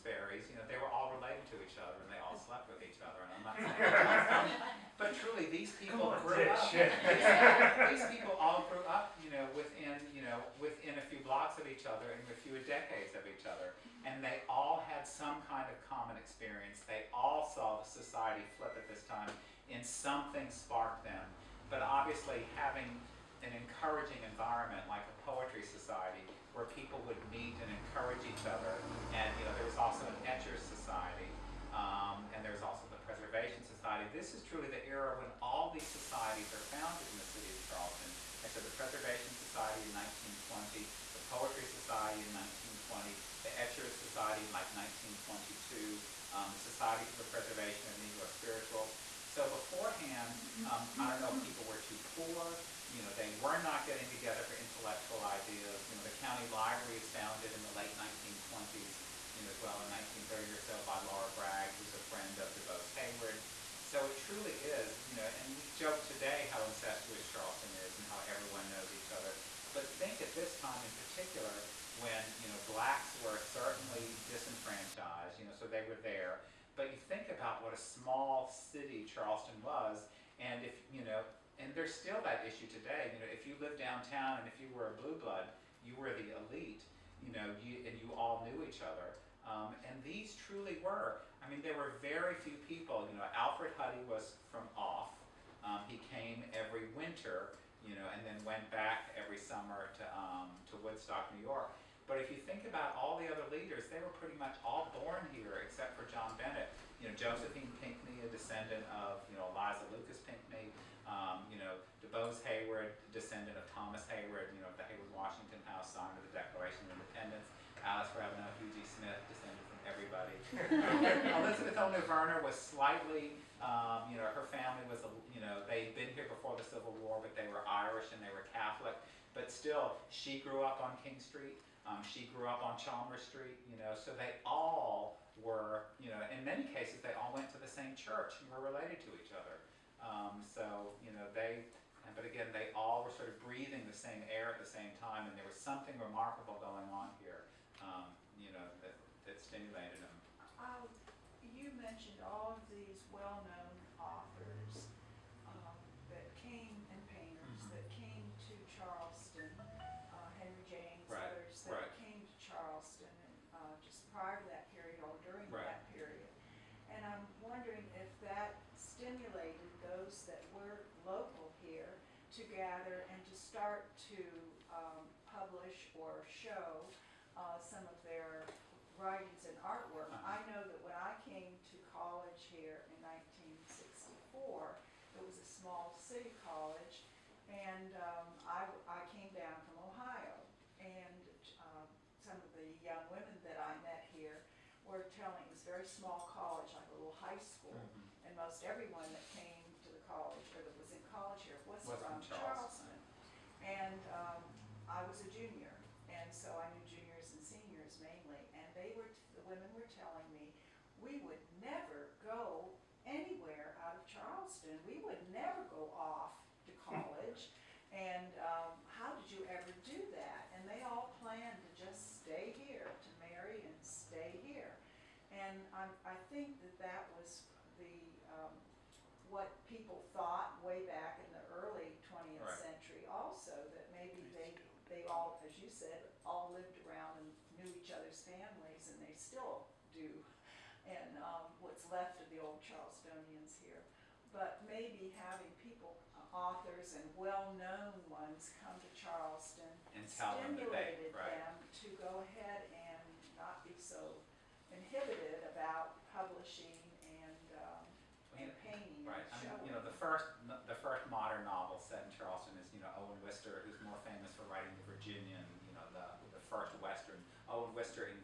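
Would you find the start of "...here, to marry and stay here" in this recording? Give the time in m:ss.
3:42.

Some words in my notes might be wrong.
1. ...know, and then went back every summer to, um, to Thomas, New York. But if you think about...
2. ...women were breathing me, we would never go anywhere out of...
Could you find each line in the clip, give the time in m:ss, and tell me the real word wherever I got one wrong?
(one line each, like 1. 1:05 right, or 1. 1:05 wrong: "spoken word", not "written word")
1. 1:37 wrong: "Woodstock", not "Thomas"
2. 3:29 wrong: "telling", not "breathing".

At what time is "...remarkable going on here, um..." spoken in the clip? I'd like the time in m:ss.
2:25.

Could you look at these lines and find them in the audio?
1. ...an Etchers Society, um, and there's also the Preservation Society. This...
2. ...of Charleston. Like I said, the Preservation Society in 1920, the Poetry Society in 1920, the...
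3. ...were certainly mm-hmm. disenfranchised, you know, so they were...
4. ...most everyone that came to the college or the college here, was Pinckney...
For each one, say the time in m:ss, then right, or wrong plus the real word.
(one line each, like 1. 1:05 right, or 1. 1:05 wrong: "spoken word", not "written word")
1. 0:30 right
2. 0:37 right
3. 1:13 right
4. 3:18 wrong: "Was", not "Pinckney".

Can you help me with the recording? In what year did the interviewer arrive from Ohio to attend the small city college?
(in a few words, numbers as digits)
1964.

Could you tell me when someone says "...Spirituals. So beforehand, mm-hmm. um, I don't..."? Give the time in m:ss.
0:48.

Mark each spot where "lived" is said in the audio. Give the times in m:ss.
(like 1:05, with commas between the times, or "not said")
1:23, 3:56.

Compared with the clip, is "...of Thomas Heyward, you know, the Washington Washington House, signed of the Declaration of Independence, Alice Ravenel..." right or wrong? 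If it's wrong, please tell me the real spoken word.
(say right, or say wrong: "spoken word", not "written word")
wrong: "Heyward", not "Washington".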